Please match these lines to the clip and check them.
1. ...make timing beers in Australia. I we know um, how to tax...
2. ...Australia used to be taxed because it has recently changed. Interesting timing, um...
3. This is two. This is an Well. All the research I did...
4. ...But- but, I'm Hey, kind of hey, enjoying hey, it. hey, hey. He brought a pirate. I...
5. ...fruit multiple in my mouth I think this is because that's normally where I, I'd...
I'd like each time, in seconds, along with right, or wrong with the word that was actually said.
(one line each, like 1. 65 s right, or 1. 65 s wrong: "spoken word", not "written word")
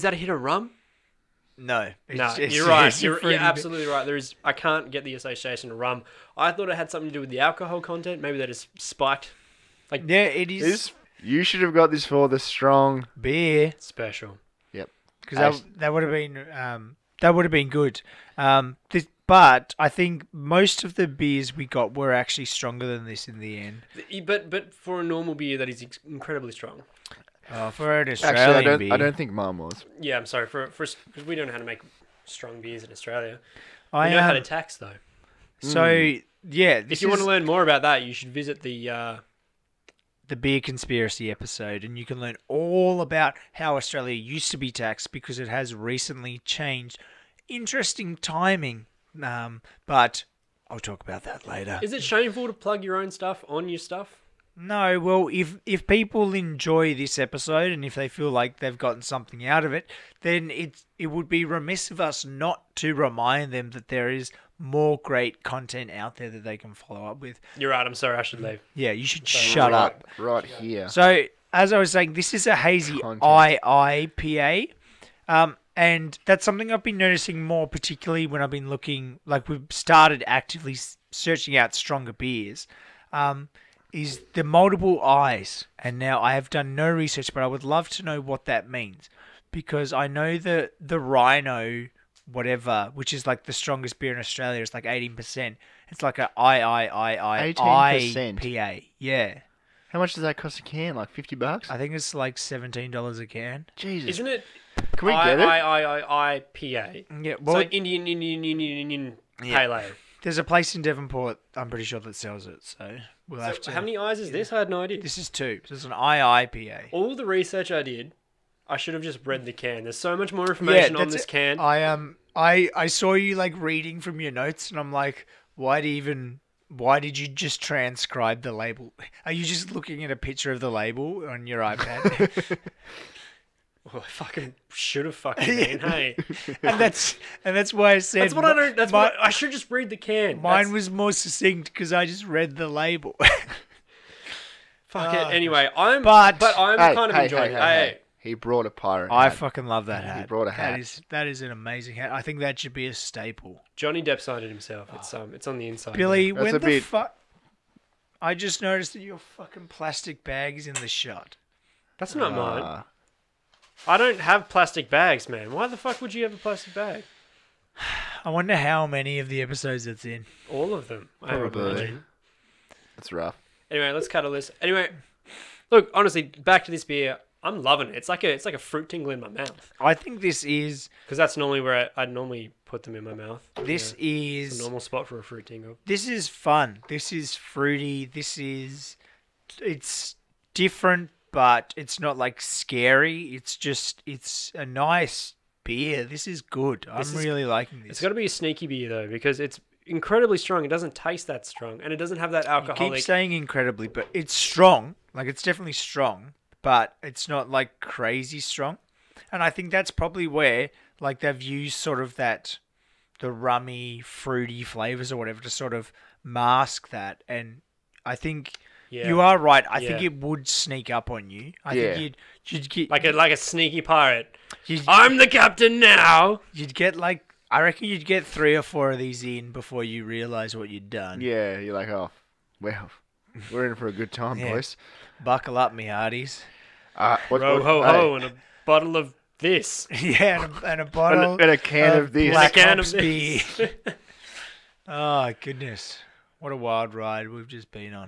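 1. 31 s wrong: "strong", not "timing"
2. 43 s right
3. 115 s wrong: "IIPA", not "Well"
4. 146 s right
5. 178 s wrong: "tingle", not "multiple".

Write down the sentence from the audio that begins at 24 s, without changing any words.
But but for a normal beer, that is incredibly strong.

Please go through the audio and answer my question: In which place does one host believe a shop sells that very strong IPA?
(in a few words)
Devonport.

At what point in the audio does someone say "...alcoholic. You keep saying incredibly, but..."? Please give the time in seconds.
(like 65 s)
202 s.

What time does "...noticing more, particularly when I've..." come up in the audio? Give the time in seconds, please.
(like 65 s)
76 s.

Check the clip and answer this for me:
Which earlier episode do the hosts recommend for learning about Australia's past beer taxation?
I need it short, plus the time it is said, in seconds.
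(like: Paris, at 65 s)
The beer conspiracy episode, at 40 s.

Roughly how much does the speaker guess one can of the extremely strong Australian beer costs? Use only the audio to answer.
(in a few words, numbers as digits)
$17.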